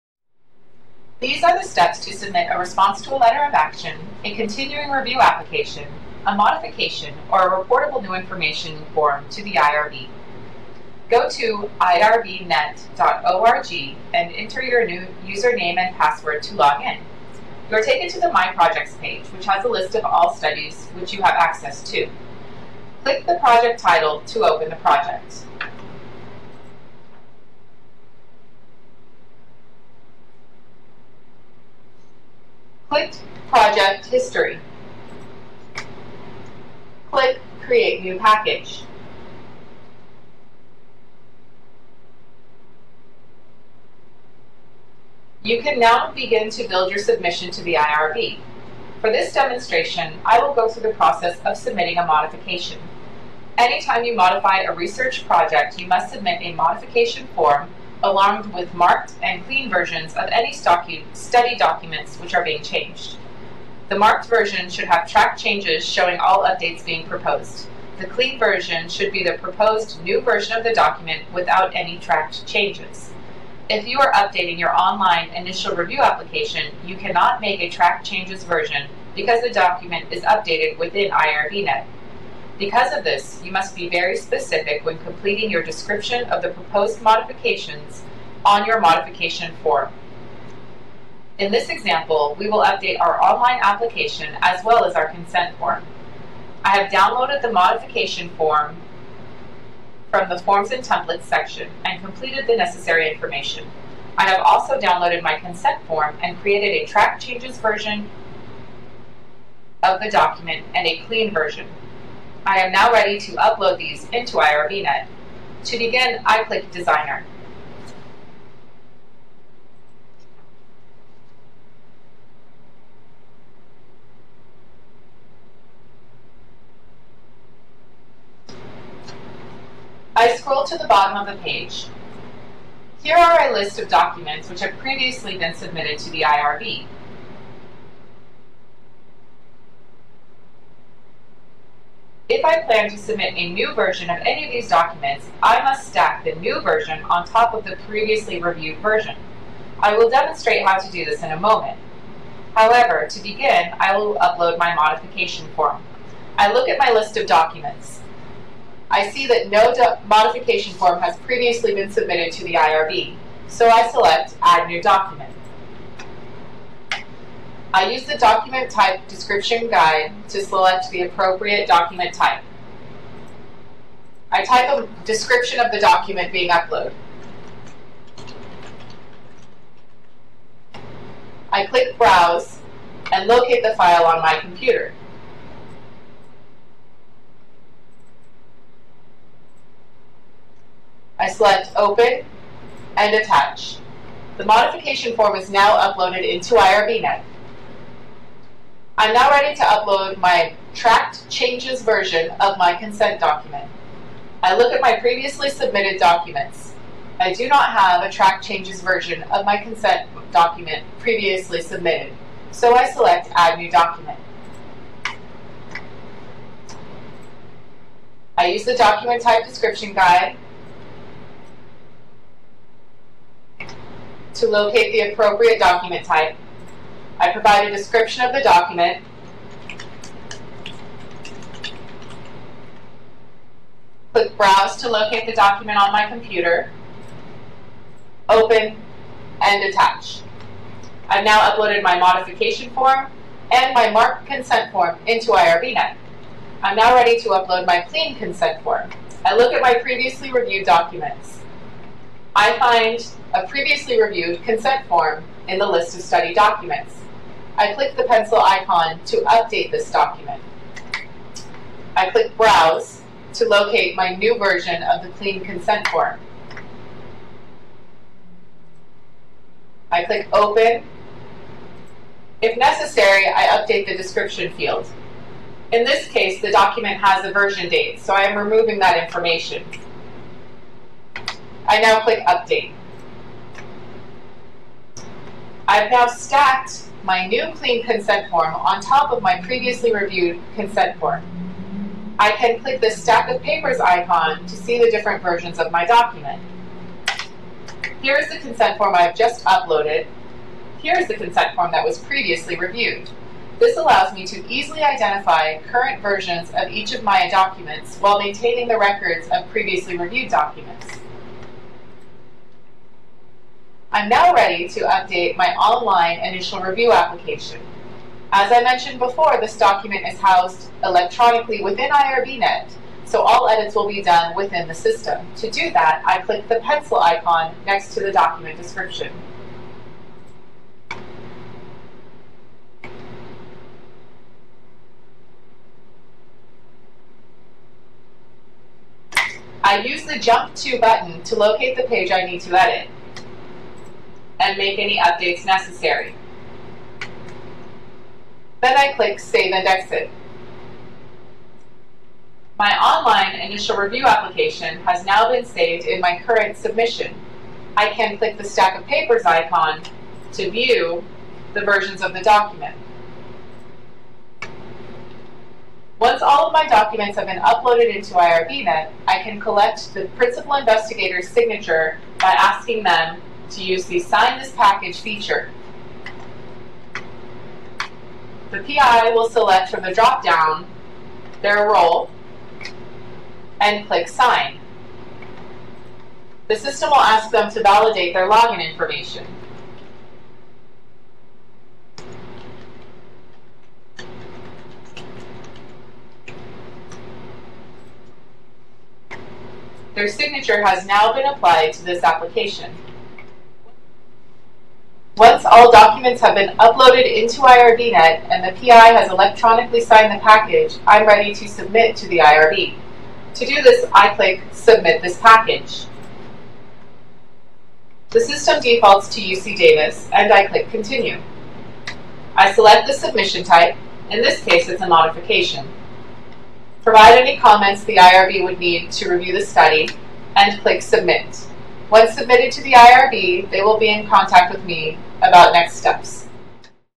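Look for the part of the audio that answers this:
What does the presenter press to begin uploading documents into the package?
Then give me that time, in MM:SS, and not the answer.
01:56.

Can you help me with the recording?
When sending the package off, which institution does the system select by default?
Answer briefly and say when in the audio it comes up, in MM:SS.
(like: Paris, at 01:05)
UC Davis, at 06:59.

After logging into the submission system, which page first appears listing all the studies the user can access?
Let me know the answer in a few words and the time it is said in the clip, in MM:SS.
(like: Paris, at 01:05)
My Projects, at 00:18.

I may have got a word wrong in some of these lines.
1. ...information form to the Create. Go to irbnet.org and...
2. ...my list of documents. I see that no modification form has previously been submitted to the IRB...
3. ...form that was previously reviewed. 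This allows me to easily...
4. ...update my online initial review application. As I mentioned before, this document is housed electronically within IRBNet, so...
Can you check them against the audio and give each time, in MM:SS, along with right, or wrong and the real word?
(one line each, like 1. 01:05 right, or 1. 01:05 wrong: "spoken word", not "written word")
1. 00:08 wrong: "IRB", not "Create"
2. 02:36 right
3. 05:01 right
4. 05:14 right.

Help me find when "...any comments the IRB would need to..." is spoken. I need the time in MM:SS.
07:07.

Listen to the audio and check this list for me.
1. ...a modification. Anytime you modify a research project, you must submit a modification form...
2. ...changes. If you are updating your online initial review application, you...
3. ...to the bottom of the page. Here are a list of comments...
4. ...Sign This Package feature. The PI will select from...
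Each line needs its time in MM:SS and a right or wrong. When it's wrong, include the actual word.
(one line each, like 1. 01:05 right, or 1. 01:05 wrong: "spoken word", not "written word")
1. 00:51 right
2. 01:12 right
3. 02:10 wrong: "documents", not "comments"
4. 06:13 right.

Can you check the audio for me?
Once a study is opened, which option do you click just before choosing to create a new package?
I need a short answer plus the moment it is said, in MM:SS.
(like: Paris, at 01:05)
Project History, at 00:33.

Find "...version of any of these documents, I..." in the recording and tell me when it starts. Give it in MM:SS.
02:23.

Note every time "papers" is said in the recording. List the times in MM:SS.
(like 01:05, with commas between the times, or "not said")
04:53, 05:58.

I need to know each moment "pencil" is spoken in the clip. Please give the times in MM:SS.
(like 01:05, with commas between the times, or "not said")
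04:18, 05:26.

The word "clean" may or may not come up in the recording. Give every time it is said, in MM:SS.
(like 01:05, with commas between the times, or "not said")
00:59, 01:08, 01:51, 04:07, 04:25, 04:47.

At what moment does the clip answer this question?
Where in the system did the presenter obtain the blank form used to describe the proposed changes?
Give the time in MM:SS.
01:40.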